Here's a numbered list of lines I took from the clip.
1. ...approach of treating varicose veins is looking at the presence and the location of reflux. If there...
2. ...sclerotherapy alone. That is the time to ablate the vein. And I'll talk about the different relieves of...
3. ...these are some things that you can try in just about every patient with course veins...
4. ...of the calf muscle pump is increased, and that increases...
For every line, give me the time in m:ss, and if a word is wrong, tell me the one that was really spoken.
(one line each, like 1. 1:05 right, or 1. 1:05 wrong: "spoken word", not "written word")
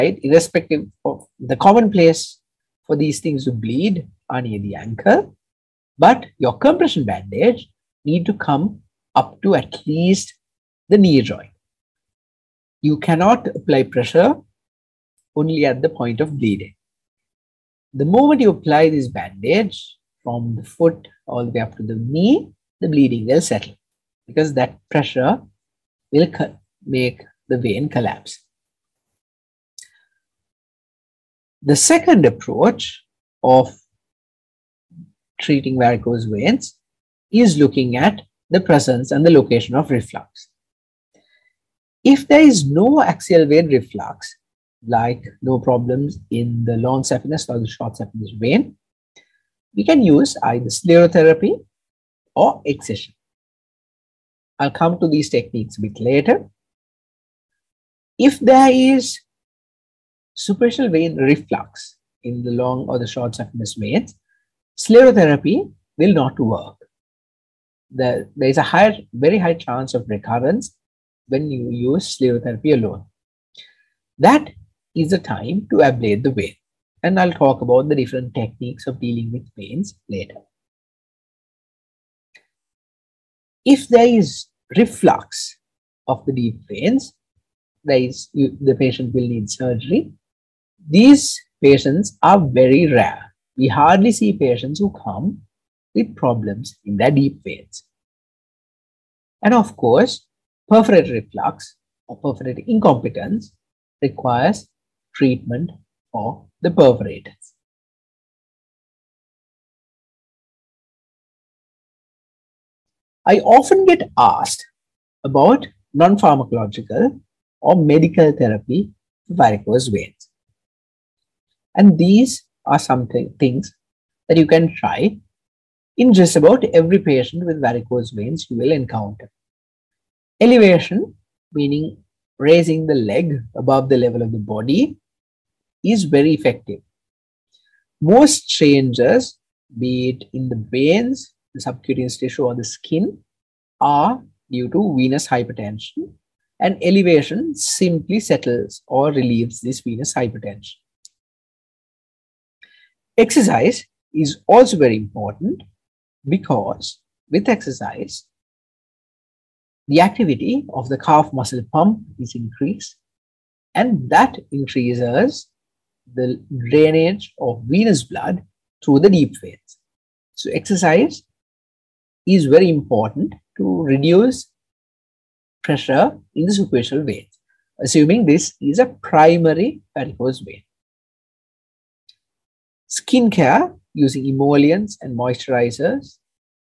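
1. 0:32 right
2. 1:12 wrong: "techniques", not "relieves"
3. 2:01 wrong: "varicose", not "course"
4. 2:40 right.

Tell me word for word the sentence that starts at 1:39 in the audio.
And of course, perforator reflux or perforator incompetence requires treatment for the perforators.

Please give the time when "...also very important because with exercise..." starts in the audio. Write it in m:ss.
2:34.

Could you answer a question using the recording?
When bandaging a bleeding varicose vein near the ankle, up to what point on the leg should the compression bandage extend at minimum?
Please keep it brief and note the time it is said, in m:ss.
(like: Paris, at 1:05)
knee joint, at 0:10.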